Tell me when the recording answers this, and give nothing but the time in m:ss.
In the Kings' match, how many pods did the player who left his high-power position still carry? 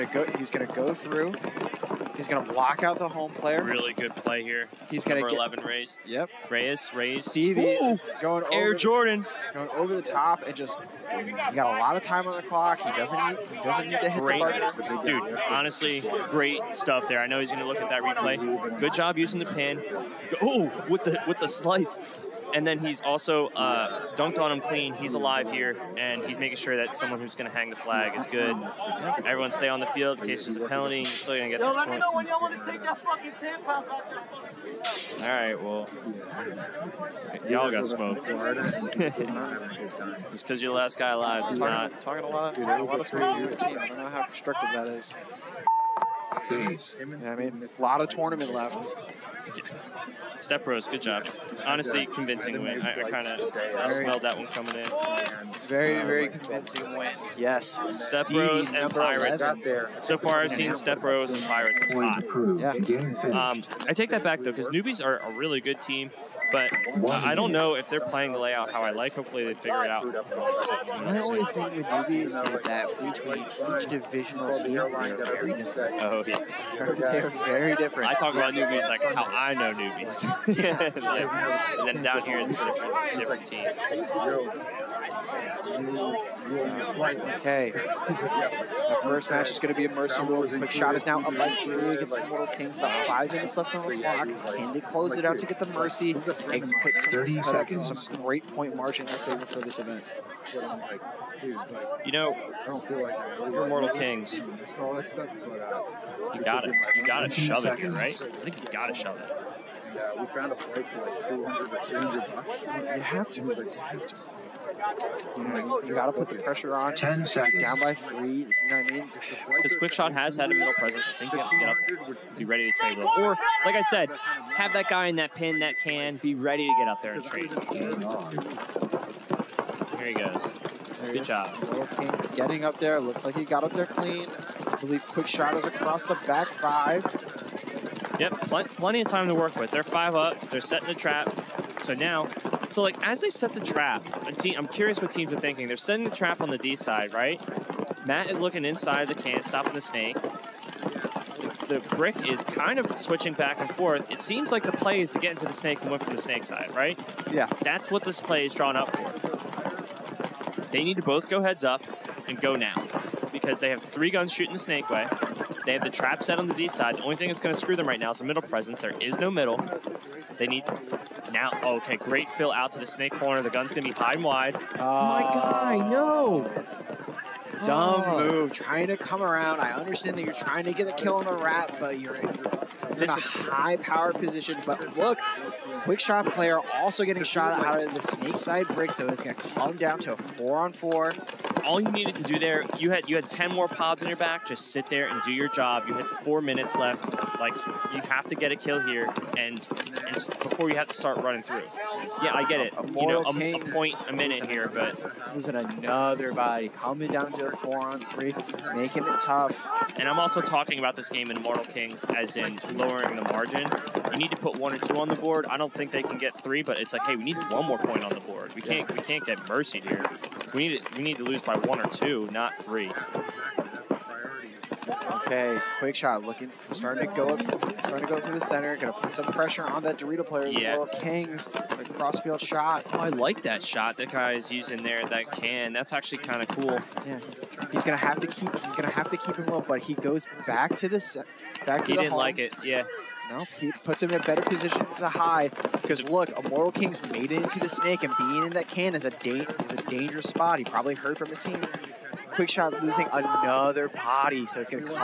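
3:13.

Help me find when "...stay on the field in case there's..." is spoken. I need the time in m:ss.
0:29.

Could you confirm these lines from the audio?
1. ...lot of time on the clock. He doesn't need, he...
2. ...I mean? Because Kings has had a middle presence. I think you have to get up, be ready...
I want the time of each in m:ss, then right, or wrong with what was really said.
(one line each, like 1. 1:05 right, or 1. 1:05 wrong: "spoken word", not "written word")
1. 0:11 right
2. 1:58 wrong: "Quickshot", not "Kings".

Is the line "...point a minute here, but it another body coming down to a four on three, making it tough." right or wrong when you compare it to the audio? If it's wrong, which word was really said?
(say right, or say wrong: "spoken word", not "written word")
right.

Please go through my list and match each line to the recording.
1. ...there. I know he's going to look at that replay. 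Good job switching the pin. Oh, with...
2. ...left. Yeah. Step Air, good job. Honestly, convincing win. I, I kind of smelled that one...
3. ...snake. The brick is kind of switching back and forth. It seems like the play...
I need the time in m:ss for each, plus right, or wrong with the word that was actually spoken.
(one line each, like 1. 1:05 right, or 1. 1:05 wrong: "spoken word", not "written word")
1. 0:17 wrong: "using", not "switching"
2. 0:48 wrong: "Bros", not "Air"
3. 2:29 right.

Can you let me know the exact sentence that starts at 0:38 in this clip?
Just because you're the last guy alive does not.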